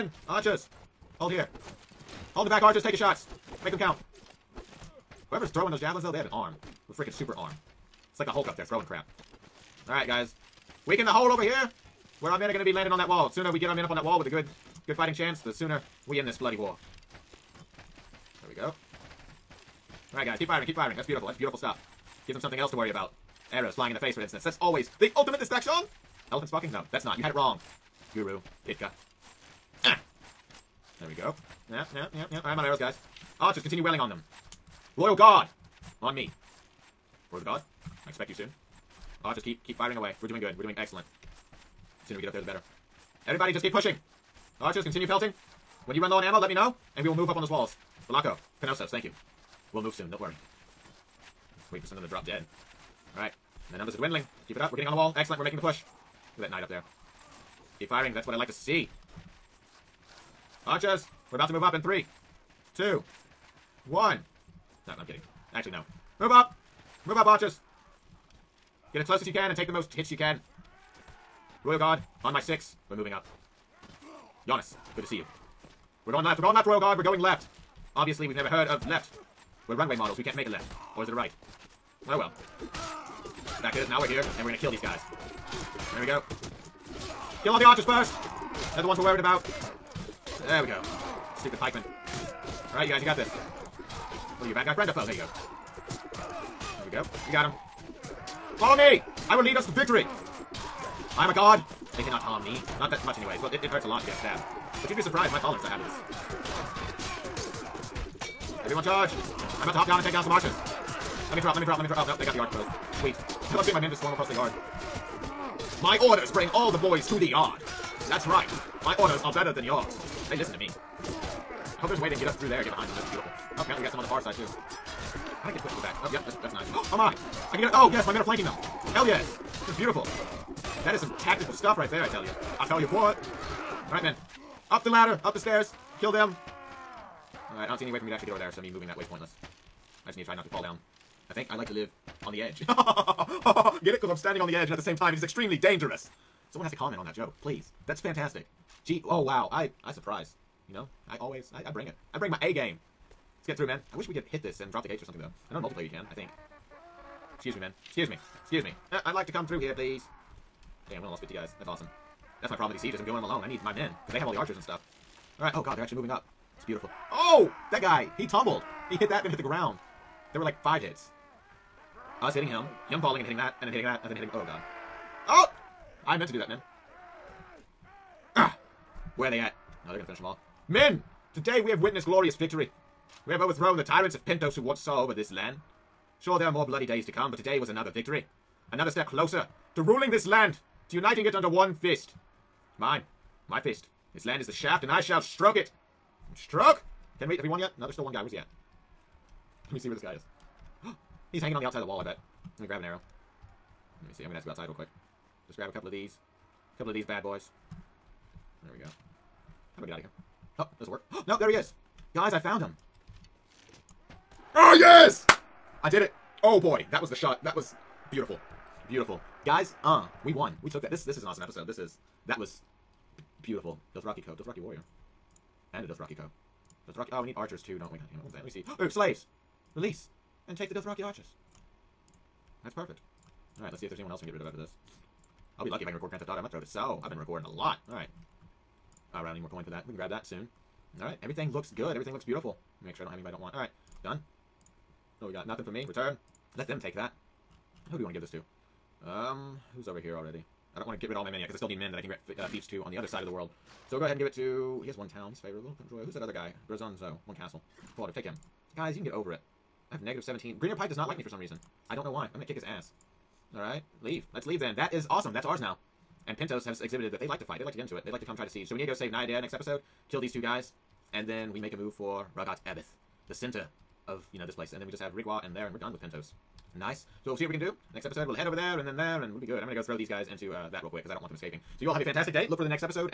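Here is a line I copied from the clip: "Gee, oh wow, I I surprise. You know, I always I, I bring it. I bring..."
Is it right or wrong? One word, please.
right.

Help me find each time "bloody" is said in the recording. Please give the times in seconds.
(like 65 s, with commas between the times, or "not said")
16 s, 186 s.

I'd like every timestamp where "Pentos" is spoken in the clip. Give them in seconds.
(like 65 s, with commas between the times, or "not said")
184 s, 266 s, 276 s.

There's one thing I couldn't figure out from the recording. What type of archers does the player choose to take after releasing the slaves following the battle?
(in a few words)
Dothraki archers.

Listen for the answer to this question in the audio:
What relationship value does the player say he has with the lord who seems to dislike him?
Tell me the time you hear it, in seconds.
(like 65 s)
260 s.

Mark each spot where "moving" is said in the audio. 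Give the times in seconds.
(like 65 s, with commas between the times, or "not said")
72 s, 138 s, 165 s.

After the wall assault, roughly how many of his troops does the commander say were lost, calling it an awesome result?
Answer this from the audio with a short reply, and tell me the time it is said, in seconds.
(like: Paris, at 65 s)
50, at 161 s.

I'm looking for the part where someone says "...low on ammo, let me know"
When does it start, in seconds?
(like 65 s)
46 s.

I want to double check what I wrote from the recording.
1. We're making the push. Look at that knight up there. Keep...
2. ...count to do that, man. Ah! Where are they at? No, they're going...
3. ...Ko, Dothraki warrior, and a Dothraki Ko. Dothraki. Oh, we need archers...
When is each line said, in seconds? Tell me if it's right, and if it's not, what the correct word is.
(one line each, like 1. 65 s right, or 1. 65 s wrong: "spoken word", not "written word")
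1. 55 s right
2. 176 s wrong: "meant", not "count"
3. 224 s right.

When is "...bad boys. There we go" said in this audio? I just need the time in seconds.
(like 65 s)
207 s.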